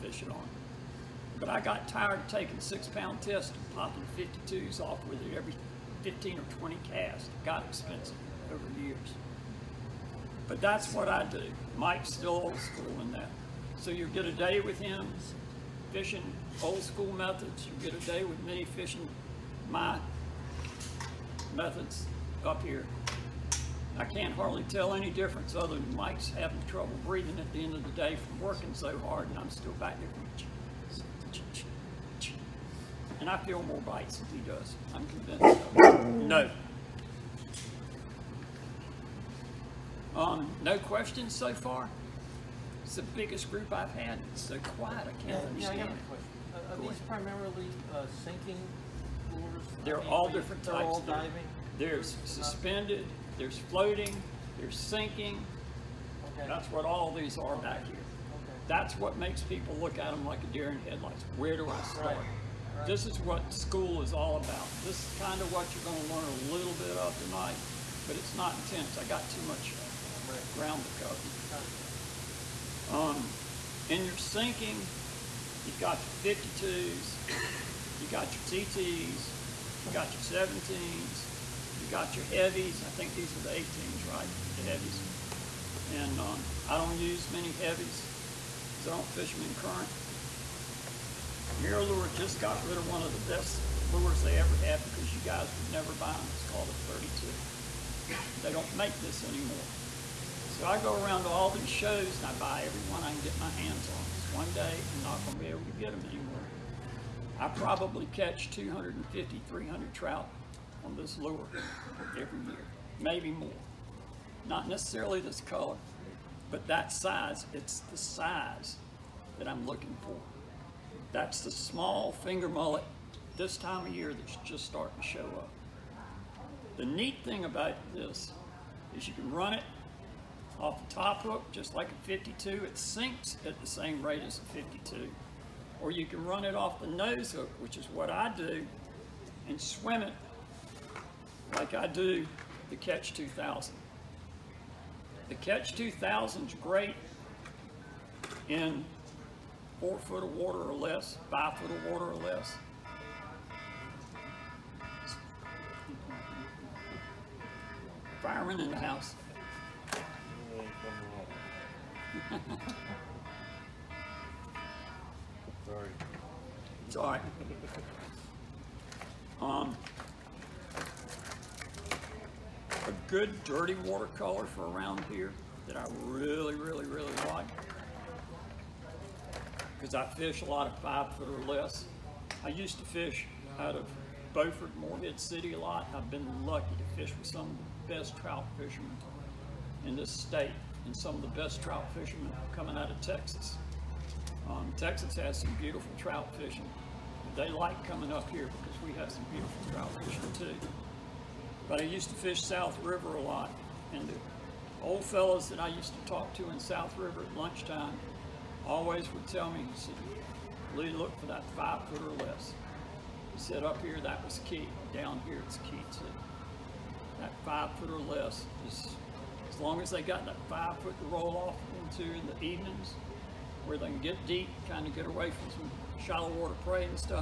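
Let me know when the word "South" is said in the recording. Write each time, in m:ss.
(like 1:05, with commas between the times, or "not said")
3:22, 3:26.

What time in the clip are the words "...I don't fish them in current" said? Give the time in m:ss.
1:28.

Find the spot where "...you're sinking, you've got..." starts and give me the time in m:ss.
1:14.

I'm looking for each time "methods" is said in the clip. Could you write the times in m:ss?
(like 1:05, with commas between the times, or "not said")
0:17, 0:21.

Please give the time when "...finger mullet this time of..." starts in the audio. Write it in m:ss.
2:02.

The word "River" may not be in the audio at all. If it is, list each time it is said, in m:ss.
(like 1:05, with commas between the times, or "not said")
3:22, 3:26.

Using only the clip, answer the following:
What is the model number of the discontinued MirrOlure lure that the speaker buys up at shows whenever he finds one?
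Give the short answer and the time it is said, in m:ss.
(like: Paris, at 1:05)
32, at 1:36.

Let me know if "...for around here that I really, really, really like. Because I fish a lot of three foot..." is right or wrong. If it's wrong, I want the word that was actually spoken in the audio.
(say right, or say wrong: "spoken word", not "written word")
wrong: "five", not "three".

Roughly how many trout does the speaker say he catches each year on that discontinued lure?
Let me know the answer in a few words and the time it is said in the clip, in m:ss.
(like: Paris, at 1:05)
250 to 300, at 1:48.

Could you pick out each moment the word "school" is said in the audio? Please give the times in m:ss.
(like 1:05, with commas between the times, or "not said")
0:12, 0:16, 1:03.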